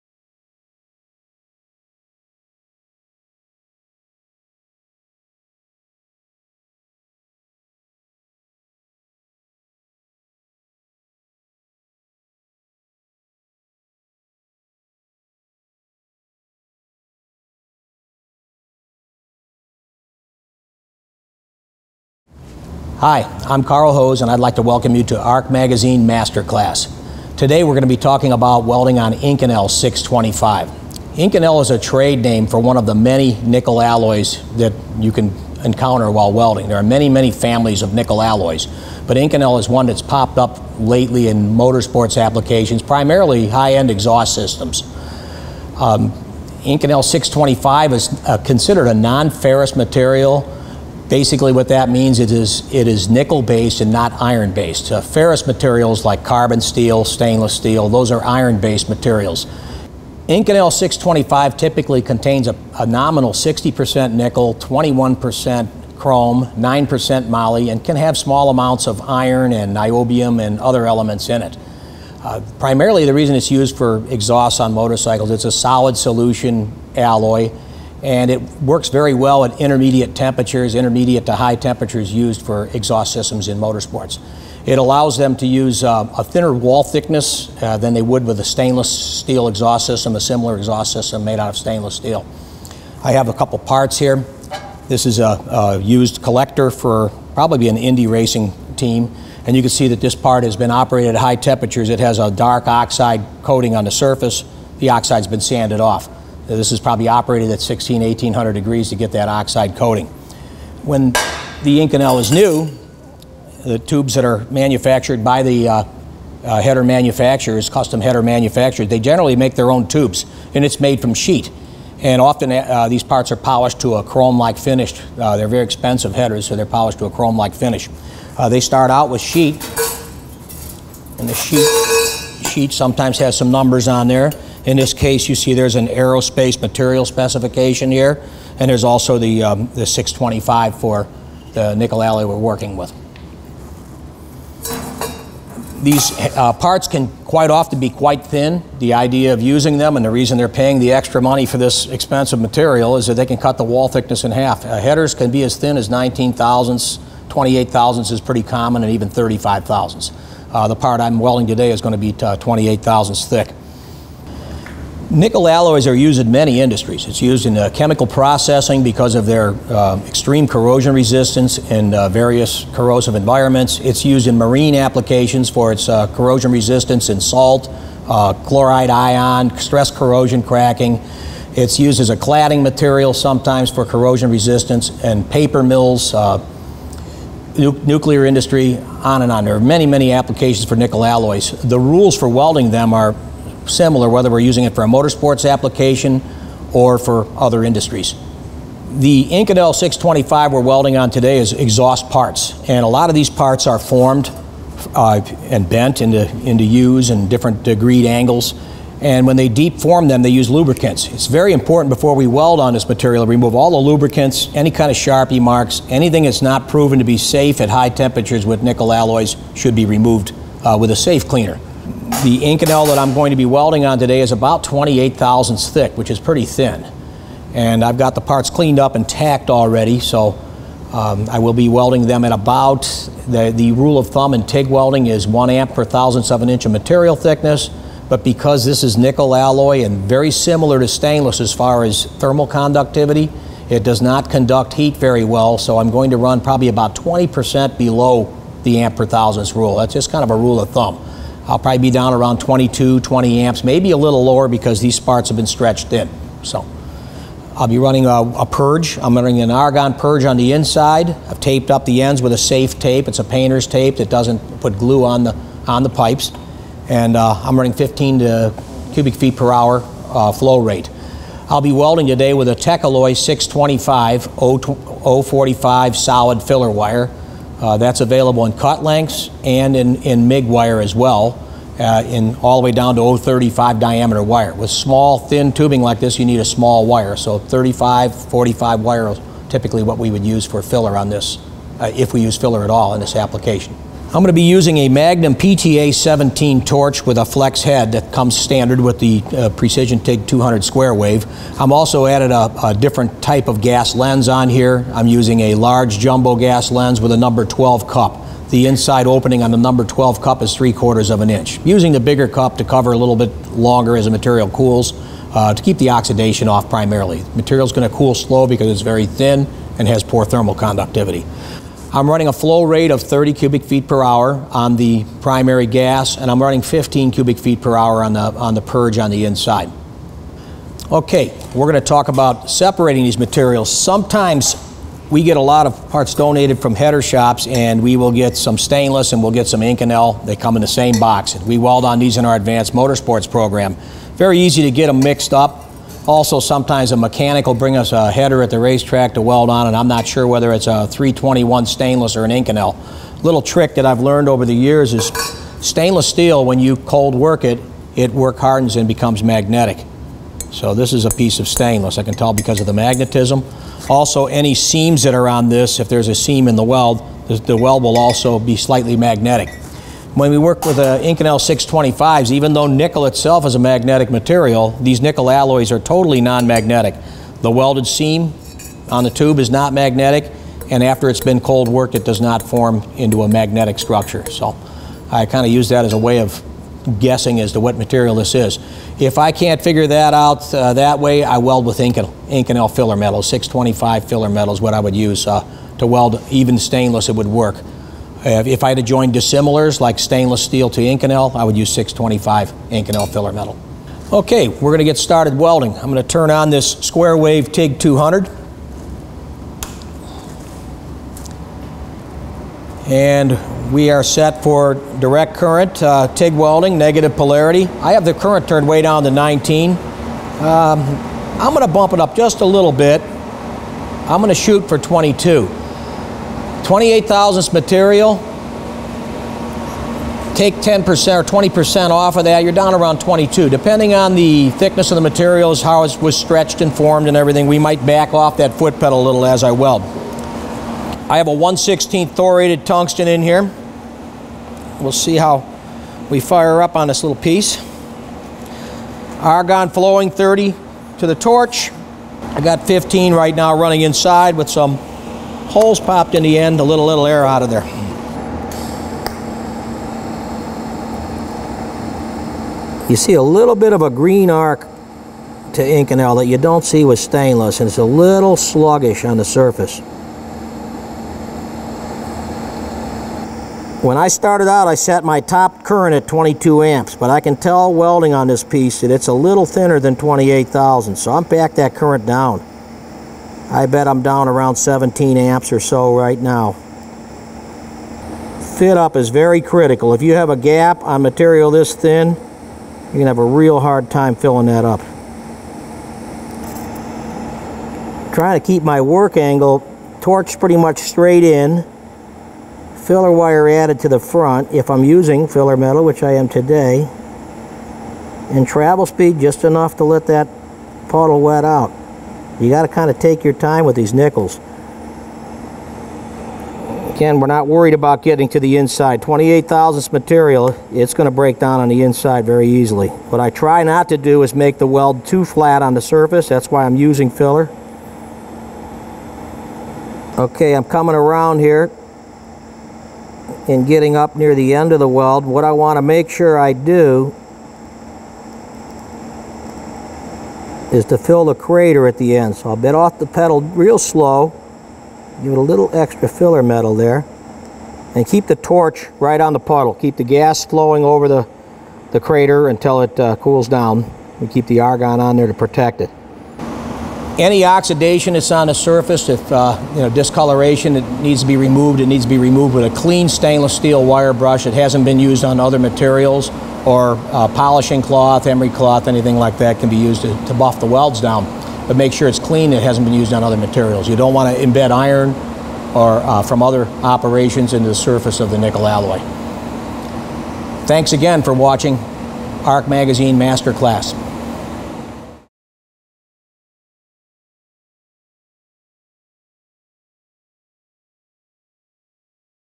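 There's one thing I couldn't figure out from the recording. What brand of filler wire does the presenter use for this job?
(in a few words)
Techalloy.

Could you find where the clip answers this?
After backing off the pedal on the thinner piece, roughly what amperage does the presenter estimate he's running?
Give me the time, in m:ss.
8:04.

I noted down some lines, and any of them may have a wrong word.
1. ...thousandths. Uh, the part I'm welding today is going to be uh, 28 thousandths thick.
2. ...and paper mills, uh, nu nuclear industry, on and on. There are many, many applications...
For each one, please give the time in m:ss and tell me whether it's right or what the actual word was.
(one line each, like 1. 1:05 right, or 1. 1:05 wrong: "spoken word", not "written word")
1. 2:39 right
2. 3:05 right.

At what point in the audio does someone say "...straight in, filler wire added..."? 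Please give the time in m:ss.
8:20.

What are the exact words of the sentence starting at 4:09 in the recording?
That's just kind of a rule of thumb.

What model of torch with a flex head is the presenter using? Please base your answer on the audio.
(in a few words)
Magnum PTA 17.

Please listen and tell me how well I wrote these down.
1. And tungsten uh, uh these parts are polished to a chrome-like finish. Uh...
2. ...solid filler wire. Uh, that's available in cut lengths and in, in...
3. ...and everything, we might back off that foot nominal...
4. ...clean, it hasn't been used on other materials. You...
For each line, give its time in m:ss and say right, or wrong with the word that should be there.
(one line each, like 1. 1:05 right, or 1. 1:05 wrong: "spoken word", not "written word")
1. 2:01 wrong: "often", not "tungsten"
2. 4:35 right
3. 7:17 wrong: "pedal", not "nominal"
4. 9:32 right.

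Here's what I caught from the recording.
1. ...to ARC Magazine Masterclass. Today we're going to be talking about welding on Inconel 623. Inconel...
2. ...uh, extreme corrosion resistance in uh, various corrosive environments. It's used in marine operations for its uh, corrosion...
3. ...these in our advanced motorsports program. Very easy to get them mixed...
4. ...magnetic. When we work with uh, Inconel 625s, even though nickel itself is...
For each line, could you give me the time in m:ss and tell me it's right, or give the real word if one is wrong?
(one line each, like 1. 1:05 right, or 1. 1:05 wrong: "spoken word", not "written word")
1. 0:25 wrong: "625", not "623"
2. 2:49 wrong: "applications", not "operations"
3. 5:41 right
4. 6:08 right.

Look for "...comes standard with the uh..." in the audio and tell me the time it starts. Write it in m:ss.
4:58.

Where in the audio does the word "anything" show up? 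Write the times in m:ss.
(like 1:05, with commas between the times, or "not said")
3:35, 9:28.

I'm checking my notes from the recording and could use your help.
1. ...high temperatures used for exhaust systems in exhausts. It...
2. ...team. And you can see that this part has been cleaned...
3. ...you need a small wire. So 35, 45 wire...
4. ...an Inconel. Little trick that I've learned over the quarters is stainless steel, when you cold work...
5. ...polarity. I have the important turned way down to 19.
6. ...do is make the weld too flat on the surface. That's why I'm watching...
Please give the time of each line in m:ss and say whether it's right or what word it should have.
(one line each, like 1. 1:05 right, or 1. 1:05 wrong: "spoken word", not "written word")
1. 1:21 wrong: "motorsports", not "exhausts"
2. 1:38 wrong: "operated", not "cleaned"
3. 4:46 right
4. 5:52 wrong: "years", not "quarters"
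5. 6:57 wrong: "current", not "important"
6. 8:43 wrong: "using", not "watching".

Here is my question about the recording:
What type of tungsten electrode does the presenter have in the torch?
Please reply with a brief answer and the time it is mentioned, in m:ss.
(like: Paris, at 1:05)
thoriated, at 7:22.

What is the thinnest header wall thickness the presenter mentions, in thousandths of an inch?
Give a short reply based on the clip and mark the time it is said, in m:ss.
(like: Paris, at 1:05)
19 thousandths, at 2:35.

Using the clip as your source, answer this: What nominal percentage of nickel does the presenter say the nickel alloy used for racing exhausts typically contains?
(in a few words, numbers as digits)
60%.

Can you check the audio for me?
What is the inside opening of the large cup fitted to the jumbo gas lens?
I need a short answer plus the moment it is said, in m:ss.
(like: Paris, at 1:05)
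three quarters of an inch, at 5:10.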